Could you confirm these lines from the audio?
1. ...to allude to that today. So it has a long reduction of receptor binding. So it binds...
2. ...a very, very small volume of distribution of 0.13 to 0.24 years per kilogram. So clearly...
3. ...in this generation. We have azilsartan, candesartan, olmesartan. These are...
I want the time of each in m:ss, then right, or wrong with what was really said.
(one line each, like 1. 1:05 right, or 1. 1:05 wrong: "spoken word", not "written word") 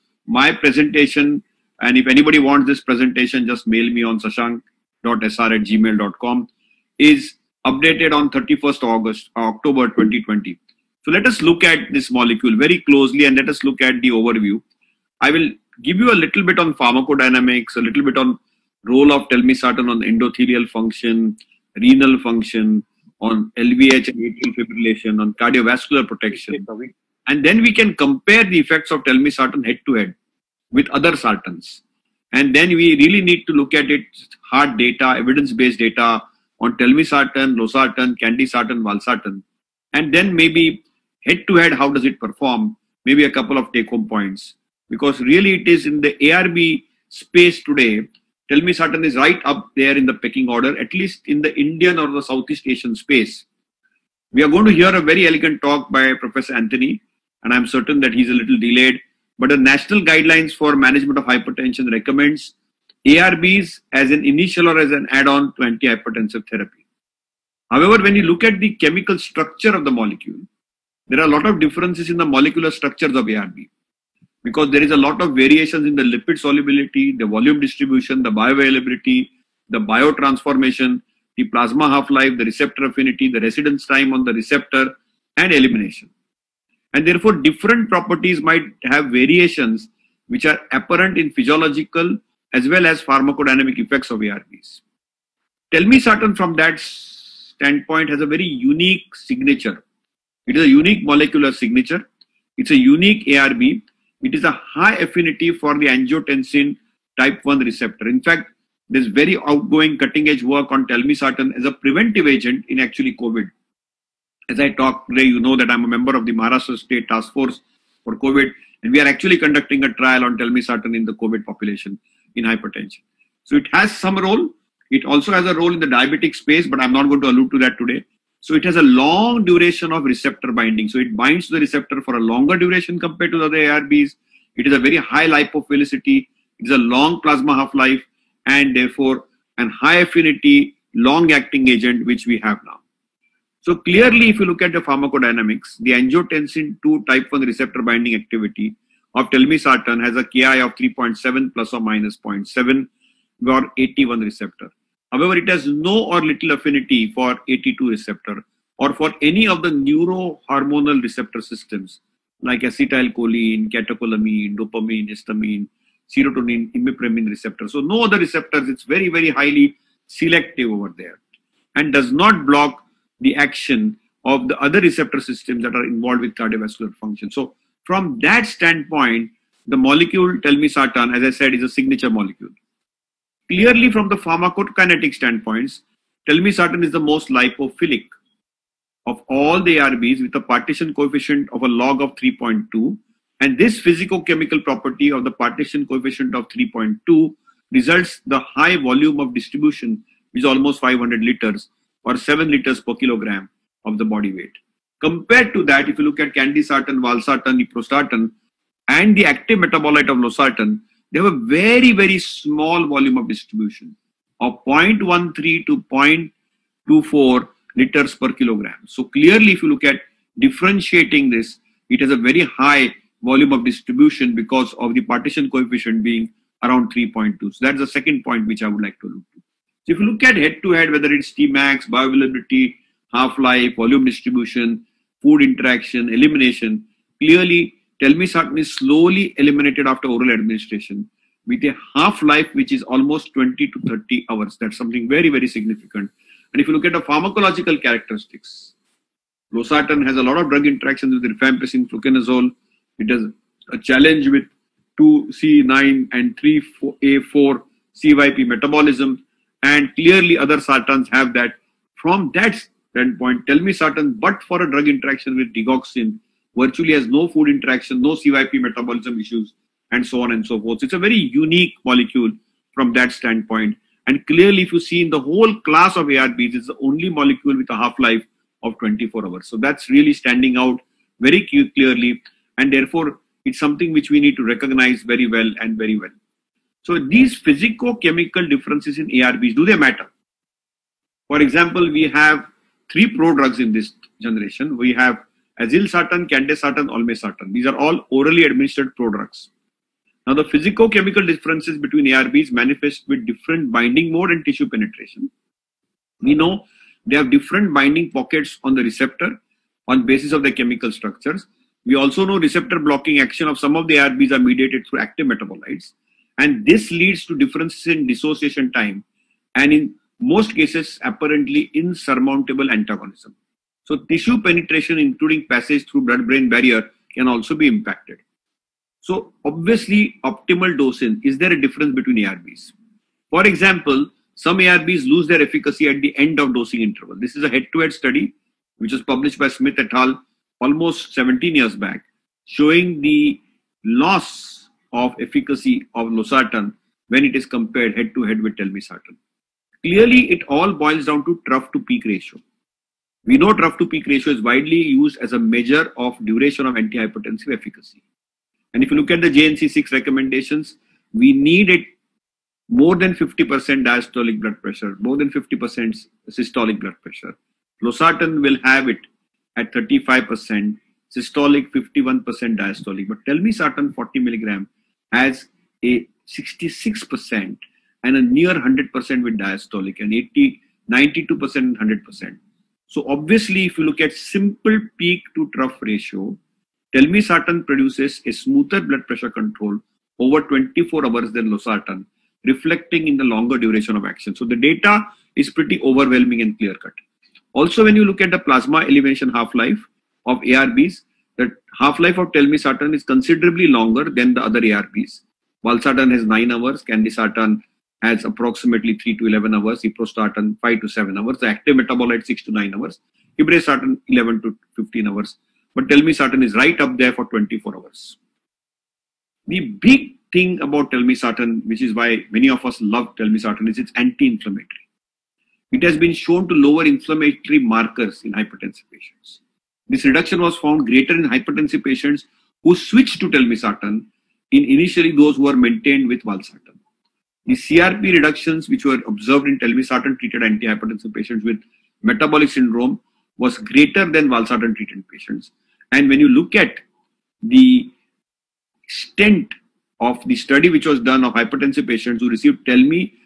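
1. 2:07 wrong: "duration", not "reduction"
2. 3:31 wrong: "liters", not "years"
3. 4:53 right.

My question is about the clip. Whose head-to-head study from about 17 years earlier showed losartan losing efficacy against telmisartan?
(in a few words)
Smith et al.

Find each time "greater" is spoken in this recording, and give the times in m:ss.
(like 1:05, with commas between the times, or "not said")
7:10, 7:23.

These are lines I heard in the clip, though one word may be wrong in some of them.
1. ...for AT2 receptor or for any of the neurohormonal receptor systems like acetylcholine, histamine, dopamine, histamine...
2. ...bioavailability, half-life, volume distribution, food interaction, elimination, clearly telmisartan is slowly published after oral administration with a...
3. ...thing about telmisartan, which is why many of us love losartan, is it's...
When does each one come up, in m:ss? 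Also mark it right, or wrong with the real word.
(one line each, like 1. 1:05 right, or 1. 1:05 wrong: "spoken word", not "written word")
1. 2:37 wrong: "catecholamine", not "histamine"
2. 3:51 wrong: "eliminated", not "published"
3. 7:00 wrong: "telmisartan", not "losartan".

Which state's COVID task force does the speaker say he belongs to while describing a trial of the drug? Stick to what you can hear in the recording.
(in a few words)
Maharashtra.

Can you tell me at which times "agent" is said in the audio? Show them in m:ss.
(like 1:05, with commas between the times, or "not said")
1:52, 2:21.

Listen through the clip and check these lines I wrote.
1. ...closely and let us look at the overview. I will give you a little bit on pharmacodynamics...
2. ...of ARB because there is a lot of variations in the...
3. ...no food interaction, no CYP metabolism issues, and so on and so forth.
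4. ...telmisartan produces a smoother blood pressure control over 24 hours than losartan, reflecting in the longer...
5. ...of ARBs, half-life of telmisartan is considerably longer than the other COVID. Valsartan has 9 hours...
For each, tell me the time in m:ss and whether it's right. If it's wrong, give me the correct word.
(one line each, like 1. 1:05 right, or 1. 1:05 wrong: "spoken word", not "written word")
1. 0:12 right
2. 1:13 right
3. 4:27 right
4. 6:26 right
5. 6:40 wrong: "ARBs", not "COVID".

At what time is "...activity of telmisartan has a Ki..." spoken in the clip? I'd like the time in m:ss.
2:28.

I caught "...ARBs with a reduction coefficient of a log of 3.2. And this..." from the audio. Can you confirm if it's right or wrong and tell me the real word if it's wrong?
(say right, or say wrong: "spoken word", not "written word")
wrong: "partition", not "reduction".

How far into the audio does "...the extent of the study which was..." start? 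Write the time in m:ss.
7:27.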